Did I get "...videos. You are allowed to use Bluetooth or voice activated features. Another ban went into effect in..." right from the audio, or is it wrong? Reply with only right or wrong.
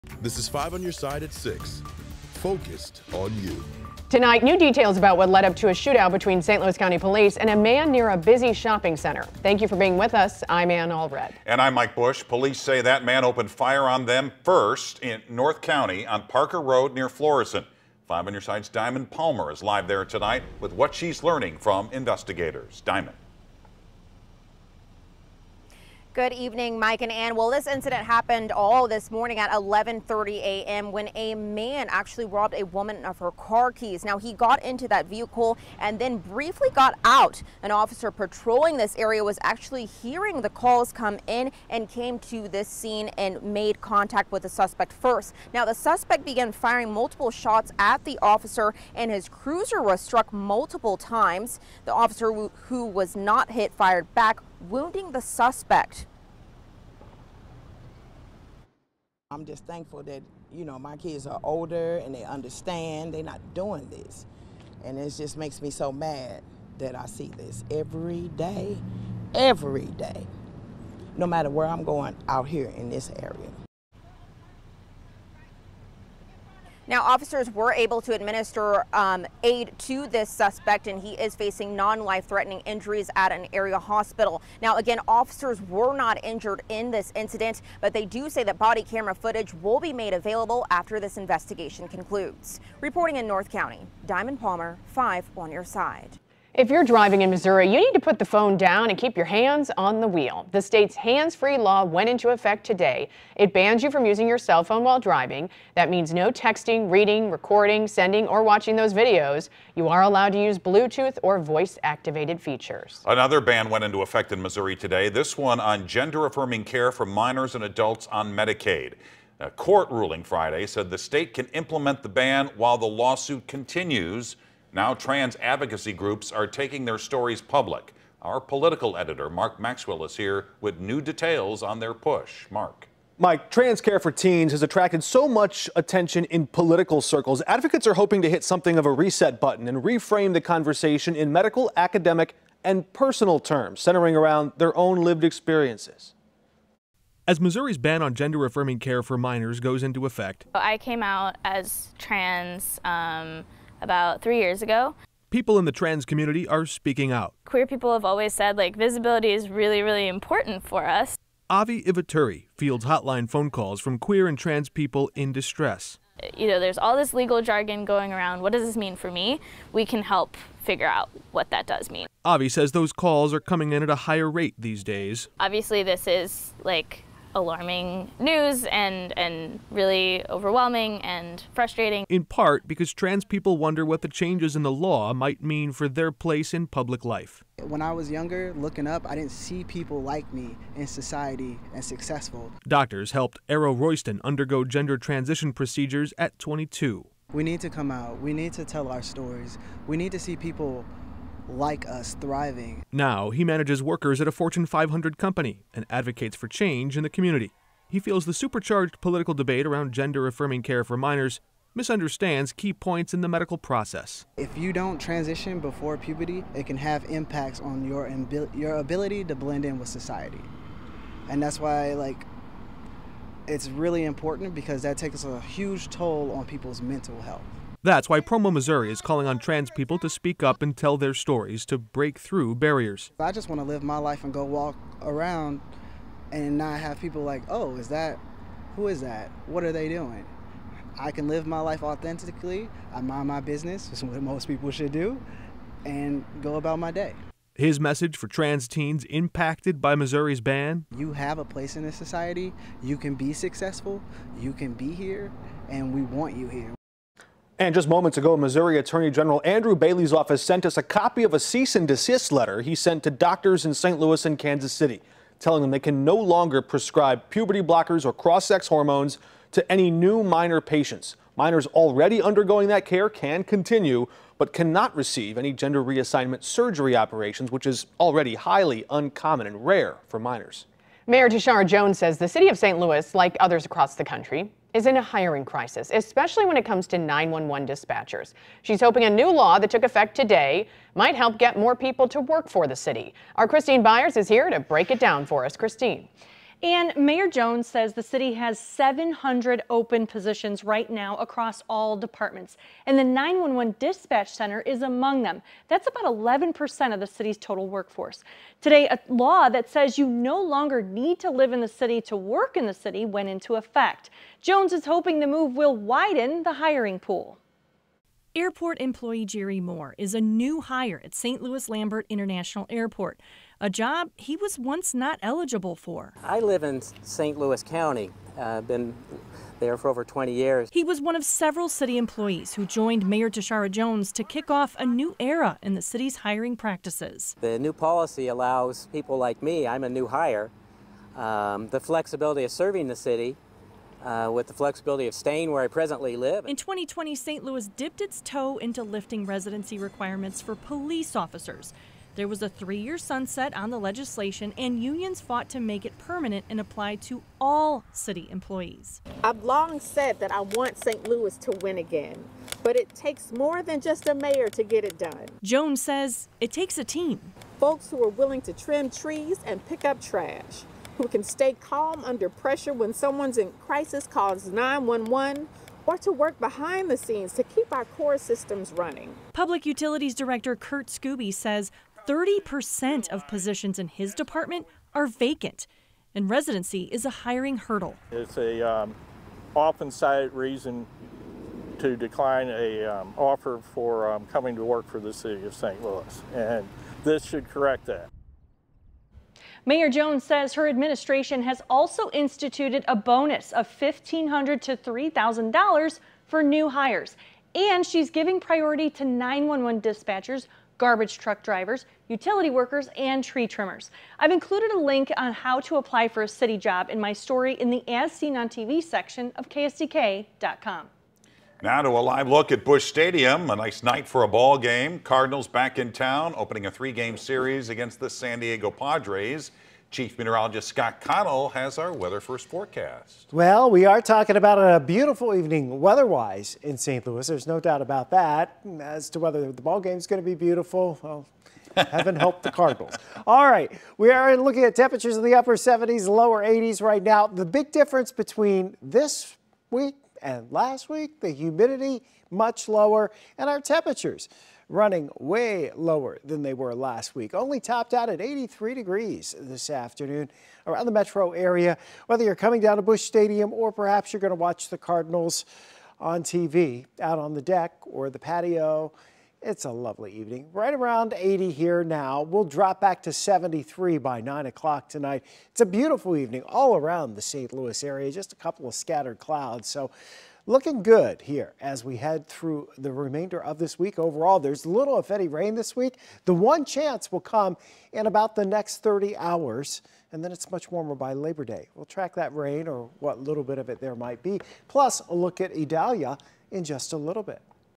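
right.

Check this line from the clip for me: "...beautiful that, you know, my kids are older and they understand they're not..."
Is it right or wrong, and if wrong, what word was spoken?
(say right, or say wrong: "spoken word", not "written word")
wrong: "thankful", not "beautiful".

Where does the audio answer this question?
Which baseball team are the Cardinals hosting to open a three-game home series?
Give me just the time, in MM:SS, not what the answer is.
07:08.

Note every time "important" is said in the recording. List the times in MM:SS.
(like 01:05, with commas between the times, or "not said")
02:40, 03:44.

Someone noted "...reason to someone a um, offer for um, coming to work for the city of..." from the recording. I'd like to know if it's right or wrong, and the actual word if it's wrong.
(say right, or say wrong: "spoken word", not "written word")
wrong: "decline", not "someone".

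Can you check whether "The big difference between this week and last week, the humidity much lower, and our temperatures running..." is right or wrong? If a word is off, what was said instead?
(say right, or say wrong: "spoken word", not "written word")
right.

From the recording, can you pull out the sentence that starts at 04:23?
Louis and Kansas City, telling them they can no longer prescribe puberty blockers or cross sex hormones to any new minor patients.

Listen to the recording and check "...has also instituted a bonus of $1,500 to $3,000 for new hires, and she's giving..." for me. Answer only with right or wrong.
right.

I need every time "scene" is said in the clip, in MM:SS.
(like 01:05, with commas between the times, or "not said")
00:42, 06:16.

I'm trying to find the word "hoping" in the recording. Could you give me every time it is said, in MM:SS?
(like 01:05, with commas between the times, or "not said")
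02:17, 04:48, 05:14.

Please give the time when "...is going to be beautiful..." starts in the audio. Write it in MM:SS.
07:19.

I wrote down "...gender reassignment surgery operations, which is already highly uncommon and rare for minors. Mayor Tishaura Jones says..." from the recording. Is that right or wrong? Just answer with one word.
right.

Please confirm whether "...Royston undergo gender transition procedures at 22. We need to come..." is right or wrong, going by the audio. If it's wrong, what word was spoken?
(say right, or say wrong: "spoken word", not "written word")
right.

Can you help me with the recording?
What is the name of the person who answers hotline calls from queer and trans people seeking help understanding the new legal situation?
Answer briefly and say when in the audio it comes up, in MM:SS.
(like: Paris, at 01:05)
Avi Ivaturi, at 02:41.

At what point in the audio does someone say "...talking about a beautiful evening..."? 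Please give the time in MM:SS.
07:14.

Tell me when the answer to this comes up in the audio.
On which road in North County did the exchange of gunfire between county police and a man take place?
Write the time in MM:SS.
00:16.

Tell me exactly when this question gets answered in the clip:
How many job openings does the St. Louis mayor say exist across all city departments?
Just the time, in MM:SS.
04:58.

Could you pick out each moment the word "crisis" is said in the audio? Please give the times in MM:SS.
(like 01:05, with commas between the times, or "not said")
04:45, 06:13.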